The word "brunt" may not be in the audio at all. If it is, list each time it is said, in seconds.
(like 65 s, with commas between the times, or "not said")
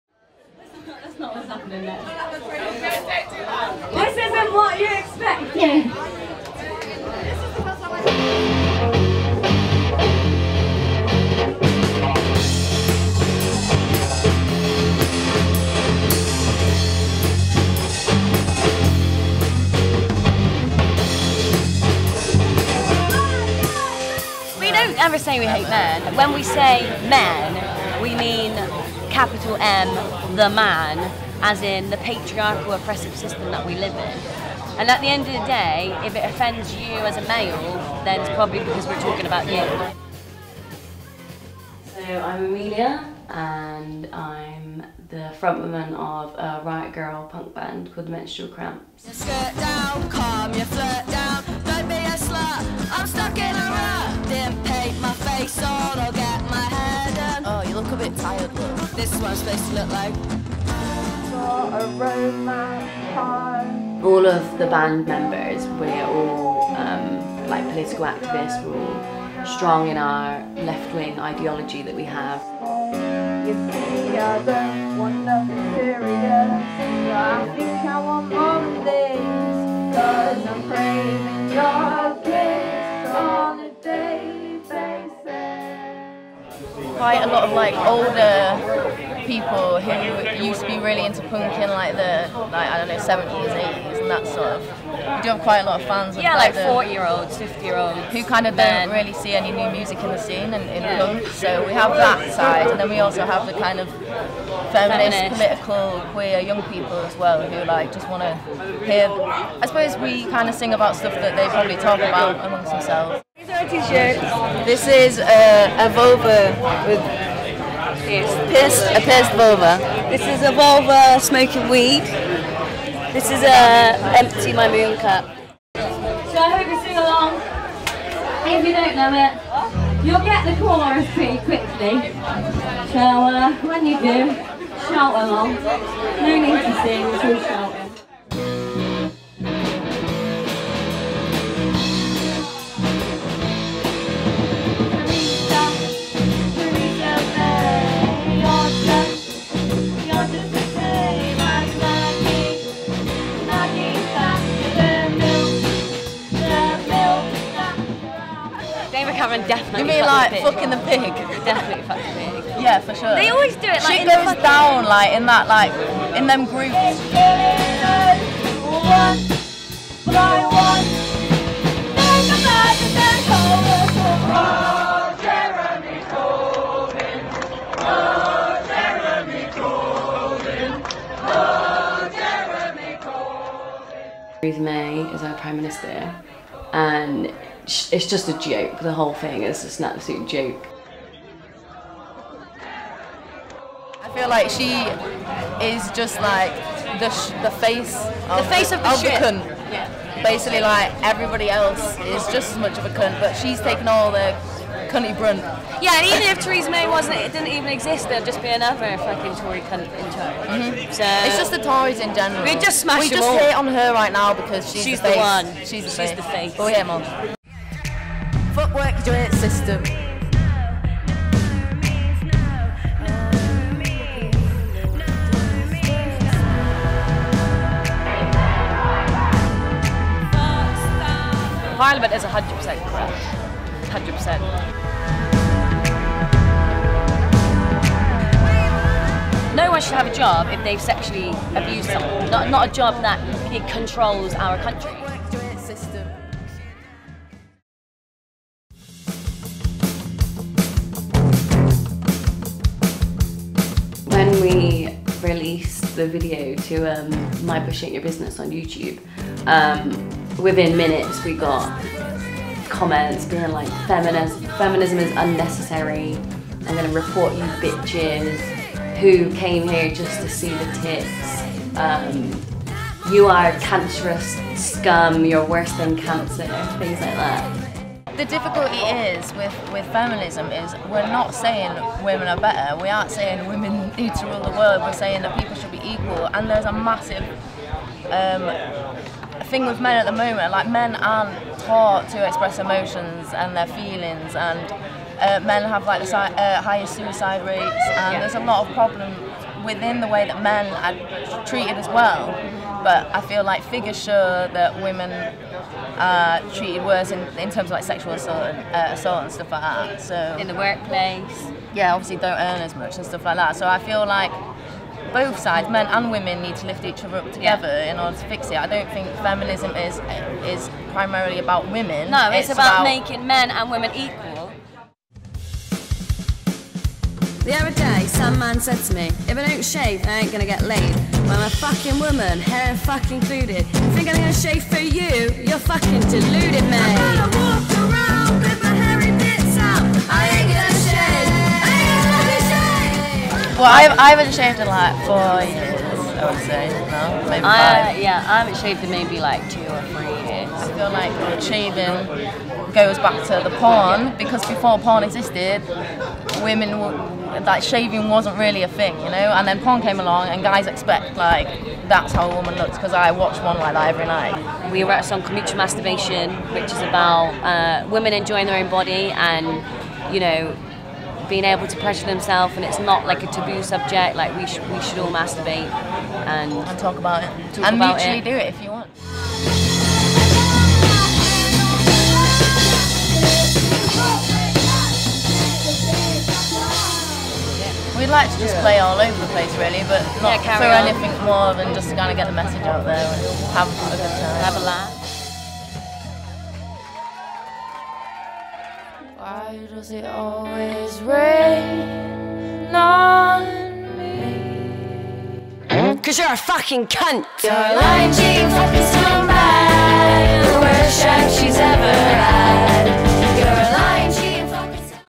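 205 s.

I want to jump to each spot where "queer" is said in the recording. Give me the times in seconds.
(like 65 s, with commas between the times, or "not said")
106 s.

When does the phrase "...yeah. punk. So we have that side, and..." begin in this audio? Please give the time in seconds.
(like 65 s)
100 s.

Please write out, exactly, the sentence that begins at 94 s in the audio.
You do have quite a lot of fans.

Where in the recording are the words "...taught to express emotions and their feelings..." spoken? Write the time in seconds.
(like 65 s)
291 s.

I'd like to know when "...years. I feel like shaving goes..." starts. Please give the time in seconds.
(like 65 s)
350 s.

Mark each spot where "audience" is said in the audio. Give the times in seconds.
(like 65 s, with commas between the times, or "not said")
not said.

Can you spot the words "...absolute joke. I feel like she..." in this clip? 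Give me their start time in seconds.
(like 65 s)
189 s.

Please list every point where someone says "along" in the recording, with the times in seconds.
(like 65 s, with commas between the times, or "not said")
126 s, 135 s, 359 s.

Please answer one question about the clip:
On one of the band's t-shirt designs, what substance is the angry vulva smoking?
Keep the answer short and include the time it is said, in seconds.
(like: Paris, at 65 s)
Weed, at 121 s.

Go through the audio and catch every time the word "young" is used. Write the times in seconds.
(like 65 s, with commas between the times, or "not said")
106 s.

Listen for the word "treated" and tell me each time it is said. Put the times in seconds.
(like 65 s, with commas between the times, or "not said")
301 s, 306 s.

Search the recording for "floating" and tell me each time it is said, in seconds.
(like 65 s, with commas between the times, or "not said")
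not said.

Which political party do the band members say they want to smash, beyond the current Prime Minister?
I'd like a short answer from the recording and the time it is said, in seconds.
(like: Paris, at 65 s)
The Tories, at 211 s.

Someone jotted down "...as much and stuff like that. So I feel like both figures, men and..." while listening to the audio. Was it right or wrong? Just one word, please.
wrong.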